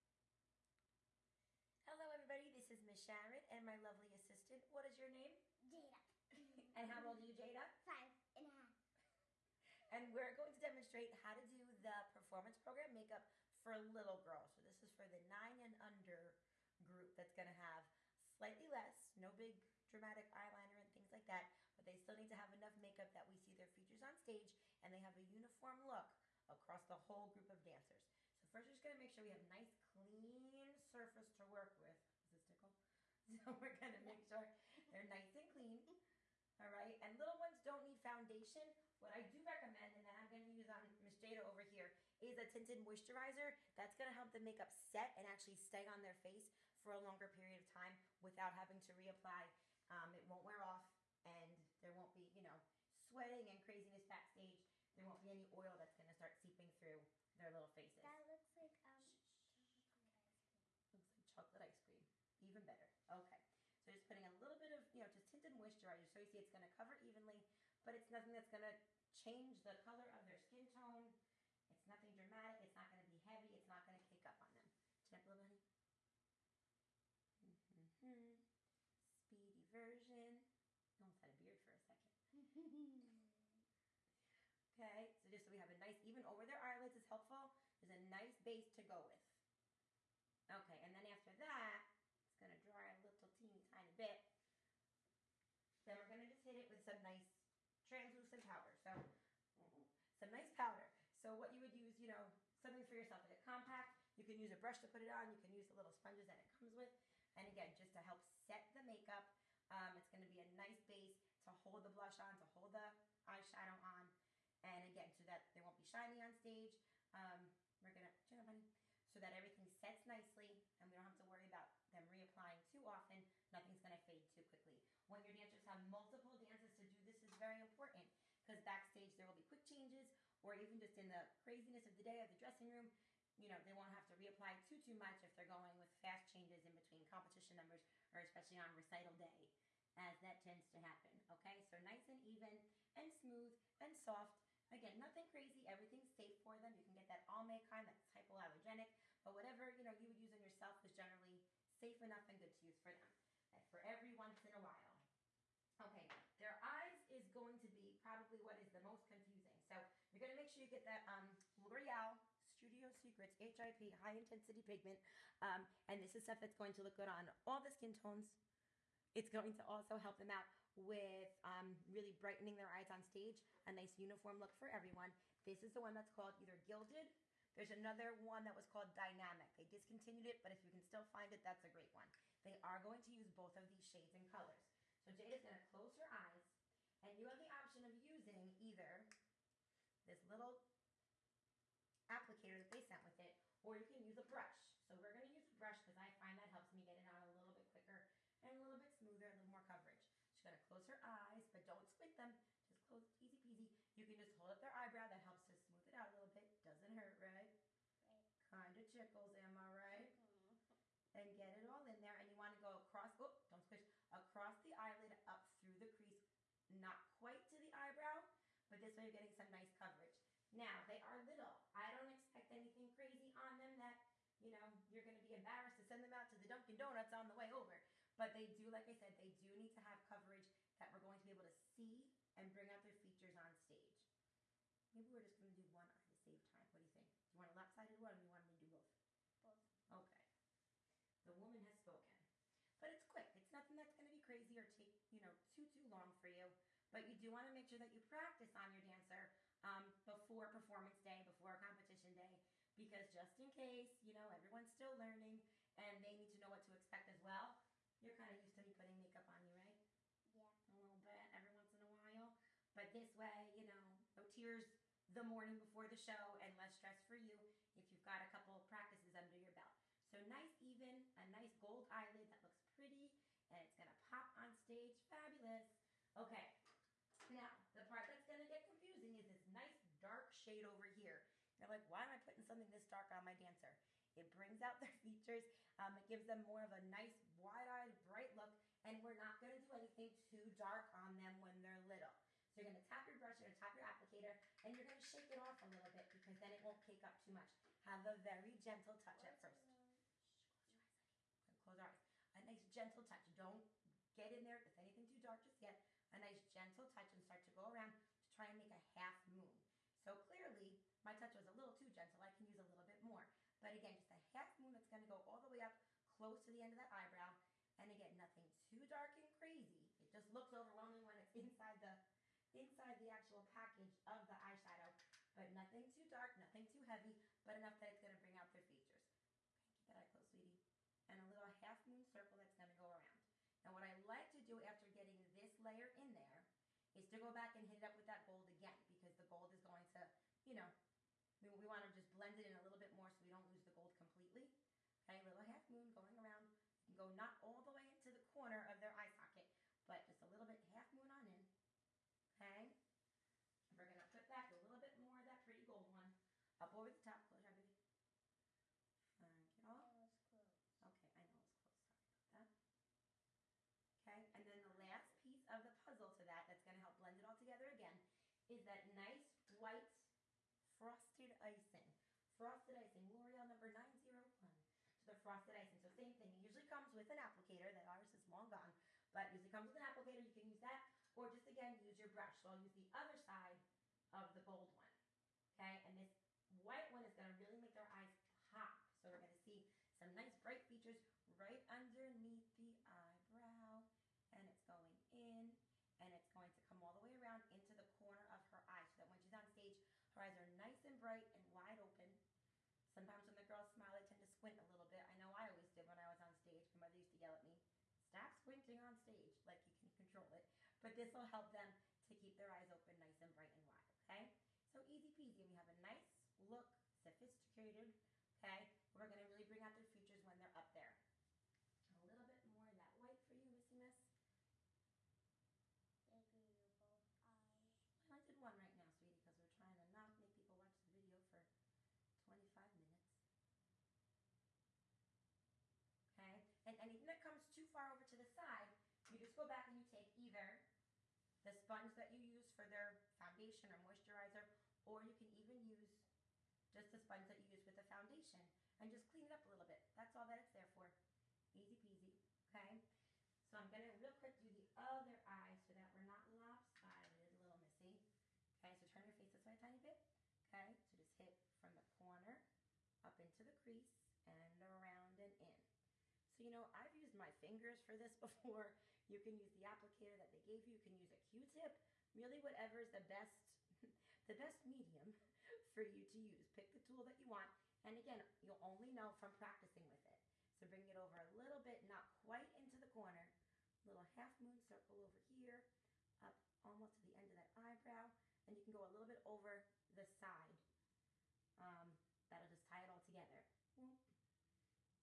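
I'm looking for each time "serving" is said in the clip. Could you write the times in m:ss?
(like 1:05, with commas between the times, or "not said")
not said.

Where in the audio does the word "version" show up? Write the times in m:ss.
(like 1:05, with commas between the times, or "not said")
1:19.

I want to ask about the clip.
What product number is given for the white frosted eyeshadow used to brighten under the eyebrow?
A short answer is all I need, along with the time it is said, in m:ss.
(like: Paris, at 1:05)
901, at 6:13.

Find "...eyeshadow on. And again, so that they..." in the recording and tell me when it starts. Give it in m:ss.
1:53.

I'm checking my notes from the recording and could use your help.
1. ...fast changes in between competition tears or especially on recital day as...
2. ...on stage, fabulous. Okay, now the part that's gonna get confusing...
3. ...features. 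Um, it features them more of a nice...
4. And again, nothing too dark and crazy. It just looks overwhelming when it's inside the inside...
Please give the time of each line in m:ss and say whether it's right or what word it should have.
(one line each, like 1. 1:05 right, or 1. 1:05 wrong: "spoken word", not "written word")
1. 2:16 wrong: "numbers", not "tears"
2. 4:34 right
3. 4:45 wrong: "gives", not "features"
4. 5:17 right.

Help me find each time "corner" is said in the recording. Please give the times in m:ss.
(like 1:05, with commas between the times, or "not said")
5:48, 6:37, 7:41, 8:02.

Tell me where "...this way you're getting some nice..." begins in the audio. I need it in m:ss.
3:38.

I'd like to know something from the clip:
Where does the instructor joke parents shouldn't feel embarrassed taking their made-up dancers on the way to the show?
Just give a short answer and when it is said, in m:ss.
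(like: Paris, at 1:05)
Dunkin' Donuts, at 3:46.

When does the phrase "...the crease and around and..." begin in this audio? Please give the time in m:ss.
7:43.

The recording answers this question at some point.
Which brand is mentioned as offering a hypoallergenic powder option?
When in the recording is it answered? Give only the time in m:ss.
2:27.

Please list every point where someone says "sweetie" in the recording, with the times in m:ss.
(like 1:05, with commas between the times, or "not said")
5:30, 7:08.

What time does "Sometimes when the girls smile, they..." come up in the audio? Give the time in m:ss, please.
6:42.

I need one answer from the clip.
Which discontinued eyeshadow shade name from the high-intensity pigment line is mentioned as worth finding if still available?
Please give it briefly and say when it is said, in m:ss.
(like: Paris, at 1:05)
Dynamic, at 2:58.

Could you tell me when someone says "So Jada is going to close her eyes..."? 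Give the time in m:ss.
3:05.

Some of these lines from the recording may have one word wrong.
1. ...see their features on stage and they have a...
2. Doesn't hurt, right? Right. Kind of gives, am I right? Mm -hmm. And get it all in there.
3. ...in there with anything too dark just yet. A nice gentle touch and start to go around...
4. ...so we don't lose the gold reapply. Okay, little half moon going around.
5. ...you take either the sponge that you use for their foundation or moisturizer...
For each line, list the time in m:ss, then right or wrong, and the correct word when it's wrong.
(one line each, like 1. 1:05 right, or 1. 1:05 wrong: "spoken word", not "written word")
1. 0:23 right
2. 3:26 wrong: "tickles", not "gives"
3. 5:04 right
4. 5:43 wrong: "completely", not "reapply"
5. 7:19 right.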